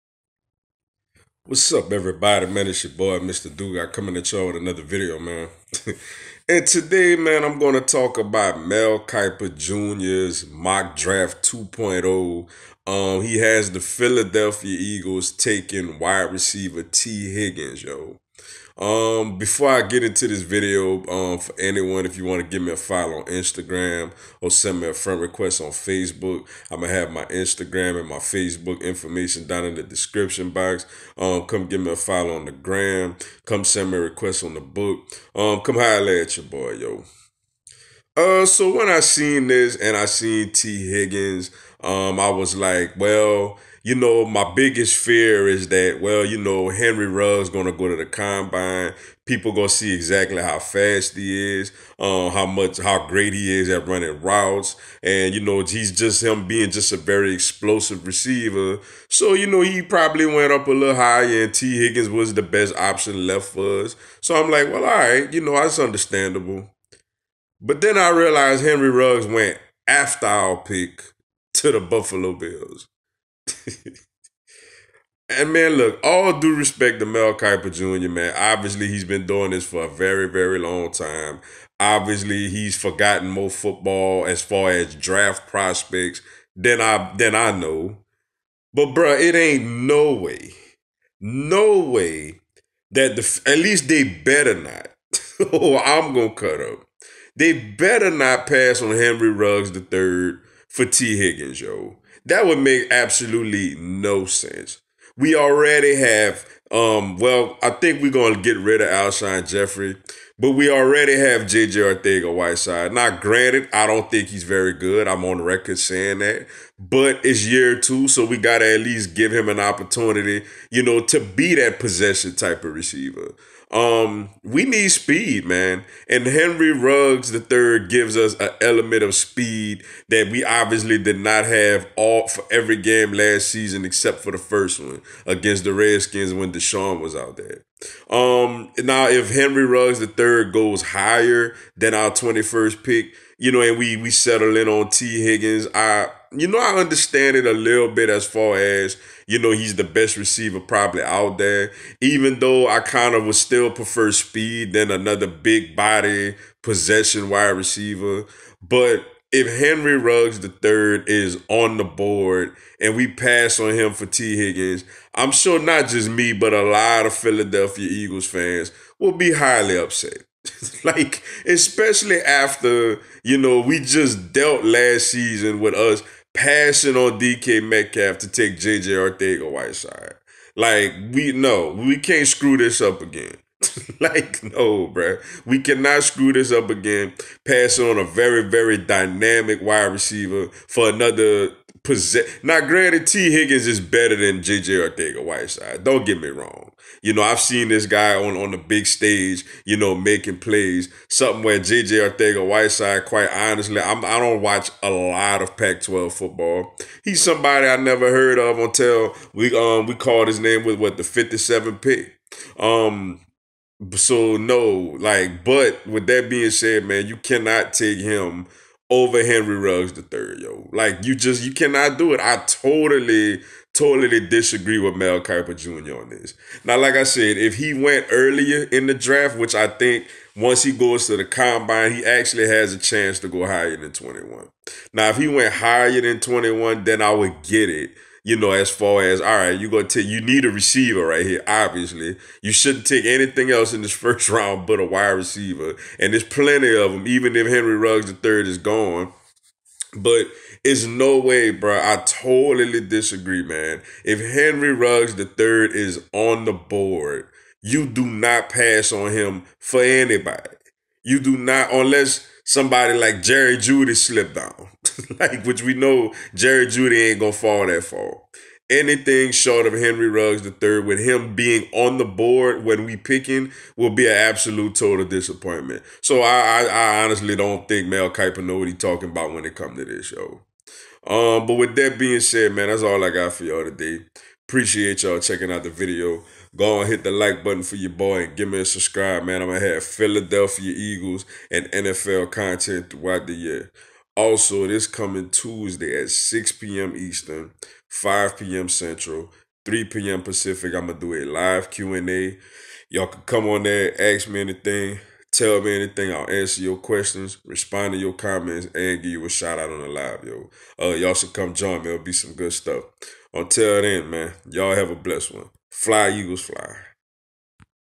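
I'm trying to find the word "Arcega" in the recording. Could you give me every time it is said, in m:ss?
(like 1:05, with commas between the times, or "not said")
1:52, 2:58, 3:14, 3:21.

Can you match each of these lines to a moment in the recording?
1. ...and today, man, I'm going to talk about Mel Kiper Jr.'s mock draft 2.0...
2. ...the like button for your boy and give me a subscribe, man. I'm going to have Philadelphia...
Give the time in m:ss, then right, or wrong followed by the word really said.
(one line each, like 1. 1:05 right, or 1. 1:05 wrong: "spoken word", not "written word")
1. 0:06 right
2. 4:47 right.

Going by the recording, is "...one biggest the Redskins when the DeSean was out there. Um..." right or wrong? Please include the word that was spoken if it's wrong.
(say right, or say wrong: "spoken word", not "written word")
wrong: "against", not "biggest".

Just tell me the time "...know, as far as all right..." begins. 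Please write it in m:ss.
3:58.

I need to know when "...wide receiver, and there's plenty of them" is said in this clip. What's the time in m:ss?
4:04.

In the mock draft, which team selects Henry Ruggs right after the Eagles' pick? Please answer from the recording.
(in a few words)
Buffalo Bills.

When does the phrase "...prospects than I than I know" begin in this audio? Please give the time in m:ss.
1:25.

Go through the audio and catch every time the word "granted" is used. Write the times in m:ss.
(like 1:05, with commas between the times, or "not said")
1:53, 3:12.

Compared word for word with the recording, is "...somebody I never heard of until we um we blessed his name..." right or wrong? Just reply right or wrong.
wrong.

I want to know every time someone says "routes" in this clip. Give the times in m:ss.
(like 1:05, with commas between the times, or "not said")
0:54.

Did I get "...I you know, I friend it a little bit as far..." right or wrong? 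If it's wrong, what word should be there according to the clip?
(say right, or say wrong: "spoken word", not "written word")
wrong: "understand", not "friend".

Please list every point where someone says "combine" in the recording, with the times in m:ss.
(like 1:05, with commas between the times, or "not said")
0:48, 3:51.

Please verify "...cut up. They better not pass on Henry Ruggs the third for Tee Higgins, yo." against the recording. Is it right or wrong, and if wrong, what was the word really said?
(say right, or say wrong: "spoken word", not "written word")
right.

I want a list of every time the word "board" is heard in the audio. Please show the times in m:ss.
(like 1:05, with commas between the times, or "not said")
2:41, 4:16, 4:32.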